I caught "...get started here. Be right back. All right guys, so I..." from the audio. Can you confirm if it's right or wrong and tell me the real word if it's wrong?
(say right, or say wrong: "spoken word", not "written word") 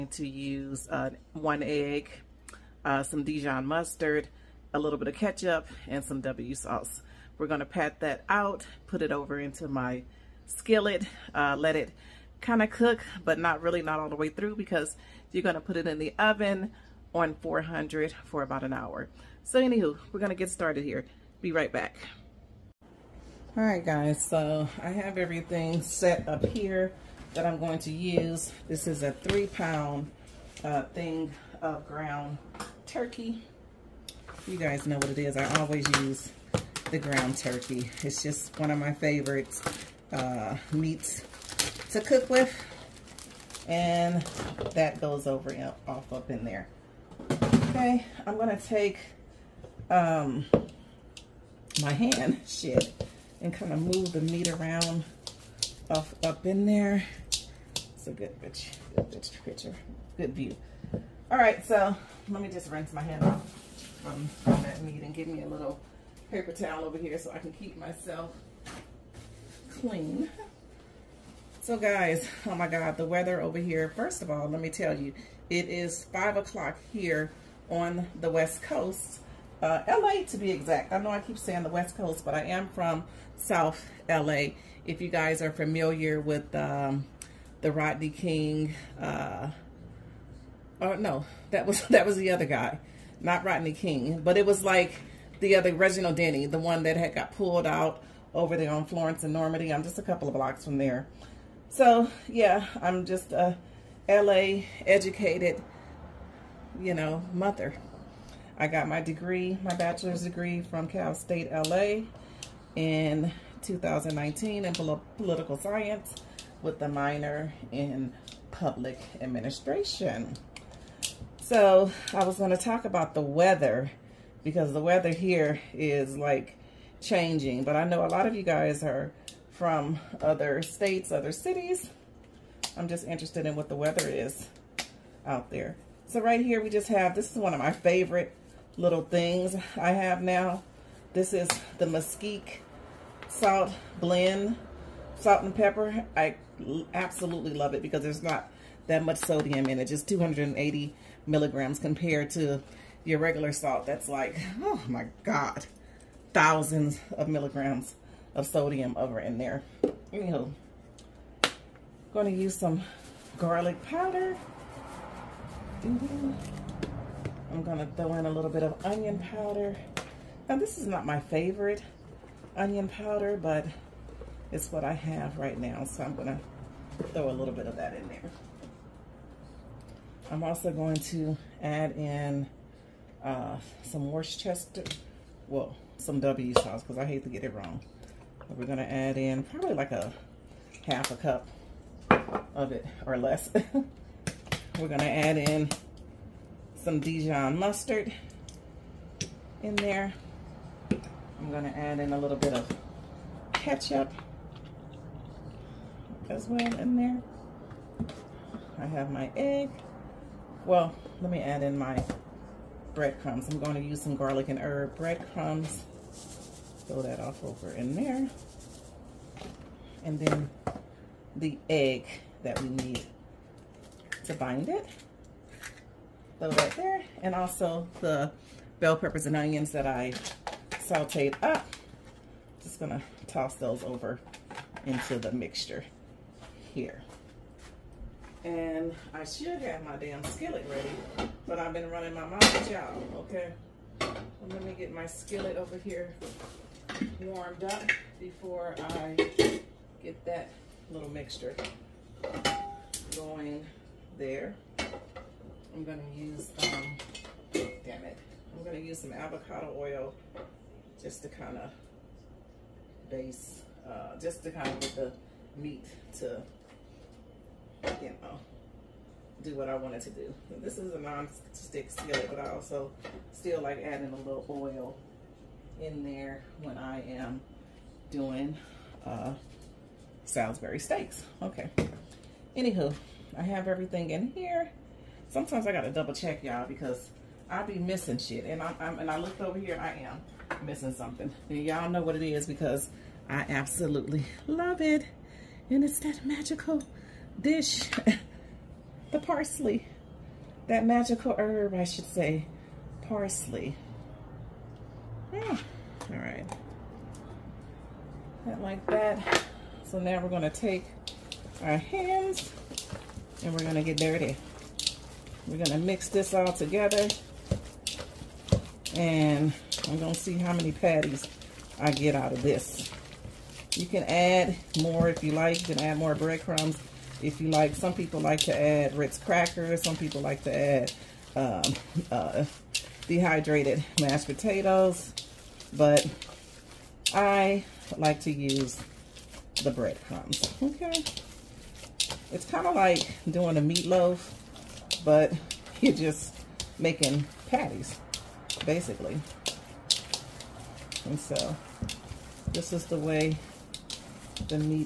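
right.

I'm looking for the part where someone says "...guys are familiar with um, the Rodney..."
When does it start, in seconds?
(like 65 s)
85 s.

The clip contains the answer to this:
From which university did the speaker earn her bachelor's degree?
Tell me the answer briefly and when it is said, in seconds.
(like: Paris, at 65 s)
Cal State LA, at 110 s.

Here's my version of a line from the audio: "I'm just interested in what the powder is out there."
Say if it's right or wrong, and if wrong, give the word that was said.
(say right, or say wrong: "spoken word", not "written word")
wrong: "weather", not "powder".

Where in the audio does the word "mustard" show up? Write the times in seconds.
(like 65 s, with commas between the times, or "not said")
3 s, 197 s.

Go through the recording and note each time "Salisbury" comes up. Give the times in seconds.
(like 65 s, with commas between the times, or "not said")
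280 s.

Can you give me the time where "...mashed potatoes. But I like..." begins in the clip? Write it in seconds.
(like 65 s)
334 s.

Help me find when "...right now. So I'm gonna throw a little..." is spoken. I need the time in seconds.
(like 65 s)
175 s.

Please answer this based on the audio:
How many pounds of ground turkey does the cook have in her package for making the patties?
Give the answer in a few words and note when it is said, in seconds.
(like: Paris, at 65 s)
3, at 29 s.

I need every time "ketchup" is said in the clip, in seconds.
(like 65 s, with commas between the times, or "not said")
5 s, 203 s.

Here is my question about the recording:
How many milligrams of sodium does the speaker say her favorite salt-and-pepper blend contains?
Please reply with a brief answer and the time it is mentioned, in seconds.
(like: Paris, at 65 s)
280, at 150 s.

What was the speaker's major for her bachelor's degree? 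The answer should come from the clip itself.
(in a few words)
Political science.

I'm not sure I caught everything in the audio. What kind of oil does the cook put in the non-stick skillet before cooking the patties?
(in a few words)
Avocado oil.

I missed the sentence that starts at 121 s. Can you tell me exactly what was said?
So I was going to talk about the weather because the weather here is like changing.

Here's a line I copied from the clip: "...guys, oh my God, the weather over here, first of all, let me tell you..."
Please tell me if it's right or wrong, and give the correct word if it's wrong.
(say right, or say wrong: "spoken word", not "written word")
right.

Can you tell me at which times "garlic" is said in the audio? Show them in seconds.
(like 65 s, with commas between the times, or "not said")
163 s, 214 s.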